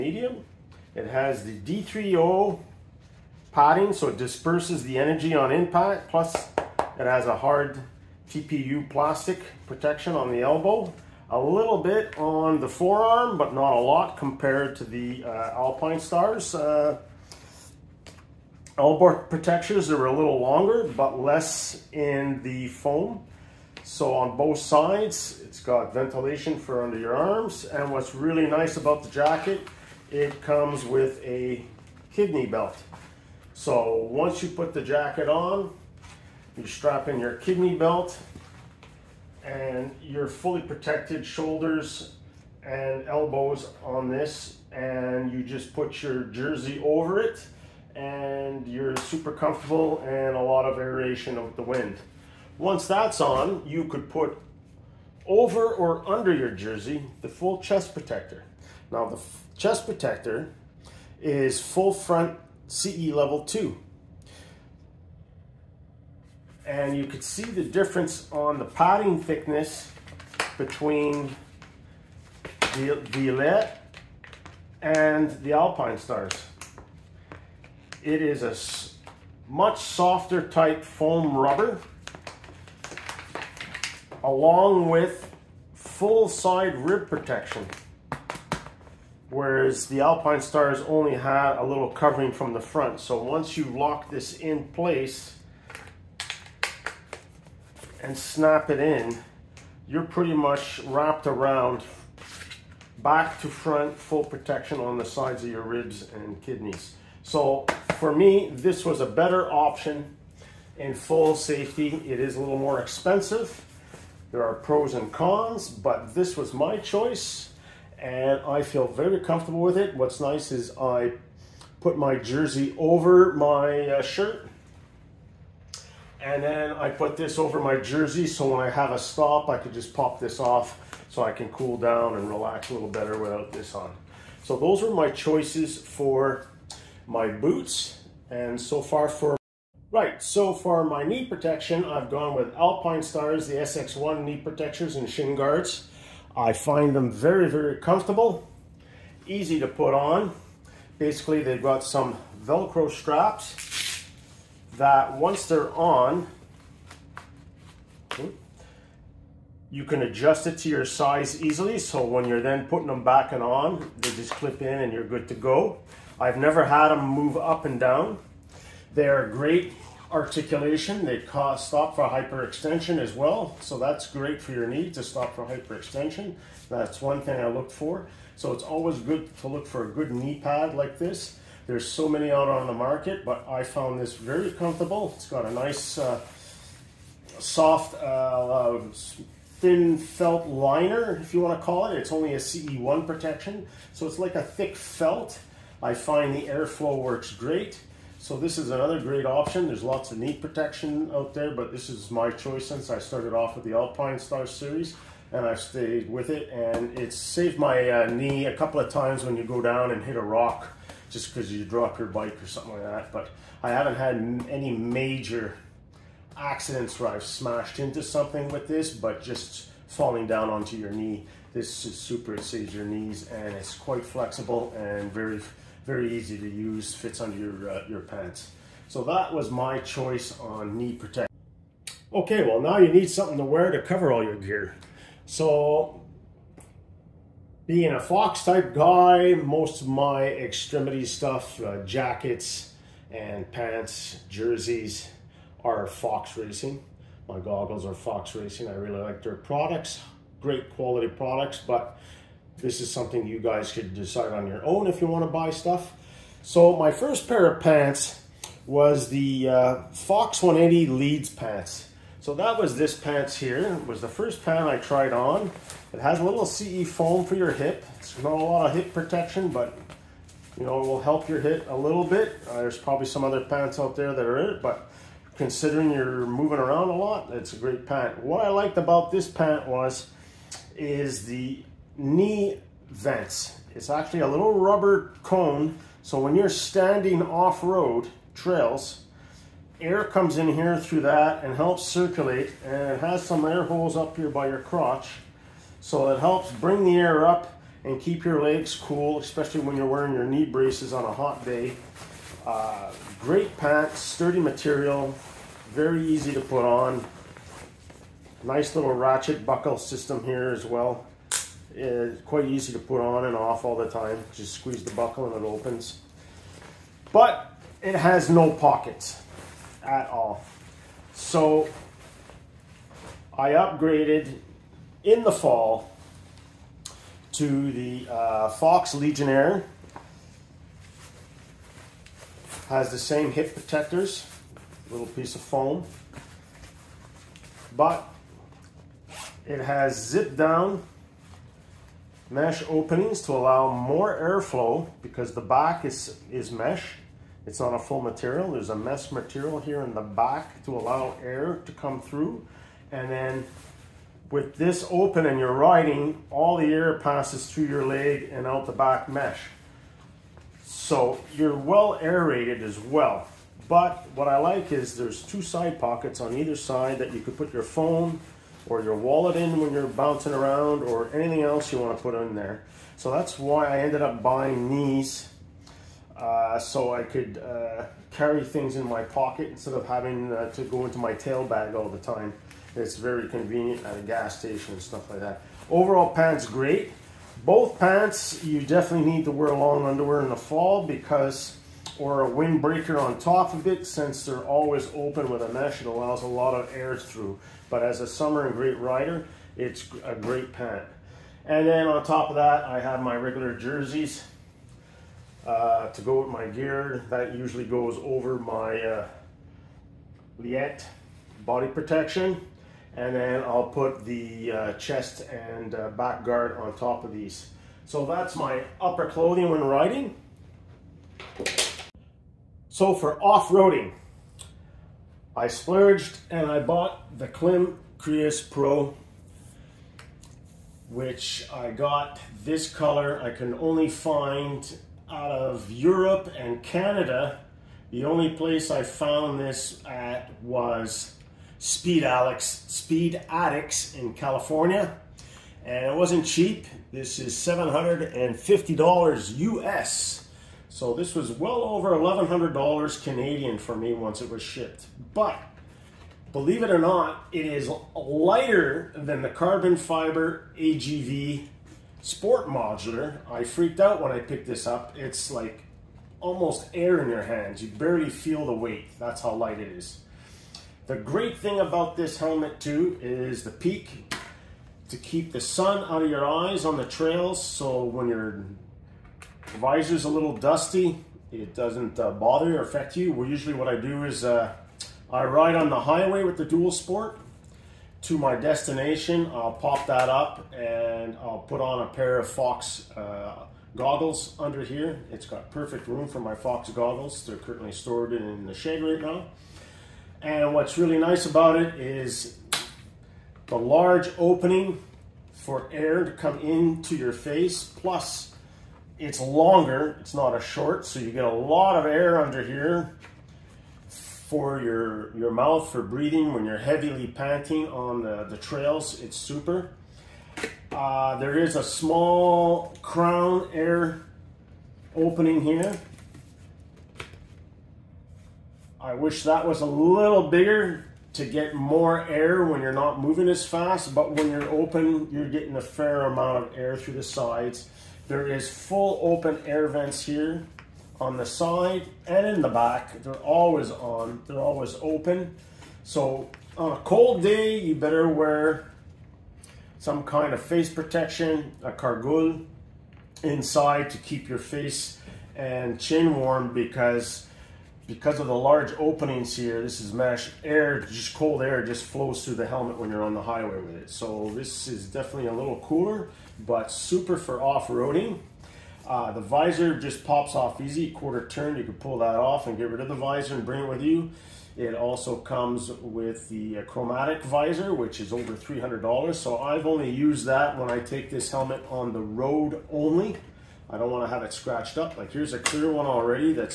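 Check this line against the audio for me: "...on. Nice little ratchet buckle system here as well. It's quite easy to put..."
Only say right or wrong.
right.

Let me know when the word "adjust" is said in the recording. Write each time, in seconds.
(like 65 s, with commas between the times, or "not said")
160 s.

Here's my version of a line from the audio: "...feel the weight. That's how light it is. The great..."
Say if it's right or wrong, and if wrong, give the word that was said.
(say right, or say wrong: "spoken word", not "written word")
right.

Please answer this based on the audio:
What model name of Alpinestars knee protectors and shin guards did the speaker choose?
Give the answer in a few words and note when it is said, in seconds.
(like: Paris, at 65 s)
SX1, at 143 s.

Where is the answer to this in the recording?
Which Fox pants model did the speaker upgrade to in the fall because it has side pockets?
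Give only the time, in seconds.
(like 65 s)
328 s.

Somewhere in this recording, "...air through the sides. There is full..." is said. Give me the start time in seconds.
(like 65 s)
536 s.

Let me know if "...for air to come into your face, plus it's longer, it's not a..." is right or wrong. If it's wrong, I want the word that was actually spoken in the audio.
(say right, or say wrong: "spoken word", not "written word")
right.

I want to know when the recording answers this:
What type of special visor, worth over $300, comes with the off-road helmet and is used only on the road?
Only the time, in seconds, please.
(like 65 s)
576 s.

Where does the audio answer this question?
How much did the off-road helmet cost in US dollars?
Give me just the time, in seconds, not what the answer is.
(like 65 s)
447 s.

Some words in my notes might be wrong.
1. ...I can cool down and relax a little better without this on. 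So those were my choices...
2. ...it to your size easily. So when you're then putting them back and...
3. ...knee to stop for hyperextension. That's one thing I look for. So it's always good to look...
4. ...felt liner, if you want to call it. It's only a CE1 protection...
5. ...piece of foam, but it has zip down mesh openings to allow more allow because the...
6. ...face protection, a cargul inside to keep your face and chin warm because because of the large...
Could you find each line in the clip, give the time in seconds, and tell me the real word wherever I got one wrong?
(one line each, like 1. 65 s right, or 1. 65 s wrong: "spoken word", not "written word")
1. 131 s right
2. 160 s right
3. 174 s right
4. 189 s right
5. 335 s wrong: "airflow", not "allow"
6. 550 s right.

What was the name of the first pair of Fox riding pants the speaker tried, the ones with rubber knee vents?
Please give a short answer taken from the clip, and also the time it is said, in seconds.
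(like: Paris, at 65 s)
Fox 180 Leeds, at 259 s.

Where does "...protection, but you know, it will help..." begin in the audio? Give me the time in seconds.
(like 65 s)
268 s.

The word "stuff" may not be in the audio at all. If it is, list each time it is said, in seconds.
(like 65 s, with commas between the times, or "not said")
241 s, 255 s, 384 s.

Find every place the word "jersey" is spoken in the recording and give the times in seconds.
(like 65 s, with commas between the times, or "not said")
46 s, 56 s, 122 s, 127 s, 244 s, 403 s.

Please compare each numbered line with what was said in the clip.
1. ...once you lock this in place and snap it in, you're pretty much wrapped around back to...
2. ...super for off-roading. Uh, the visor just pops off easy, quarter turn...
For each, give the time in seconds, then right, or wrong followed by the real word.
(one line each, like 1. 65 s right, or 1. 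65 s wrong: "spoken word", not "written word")
1. 93 s right
2. 566 s right.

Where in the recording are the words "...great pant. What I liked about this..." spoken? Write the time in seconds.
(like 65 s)
277 s.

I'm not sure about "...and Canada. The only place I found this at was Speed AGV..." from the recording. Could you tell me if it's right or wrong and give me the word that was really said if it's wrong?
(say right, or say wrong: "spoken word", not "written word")
wrong: "Alex", not "AGV".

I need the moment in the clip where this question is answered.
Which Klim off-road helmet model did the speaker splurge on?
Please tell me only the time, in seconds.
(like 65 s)
427 s.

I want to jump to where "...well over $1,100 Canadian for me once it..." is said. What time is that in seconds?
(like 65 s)
451 s.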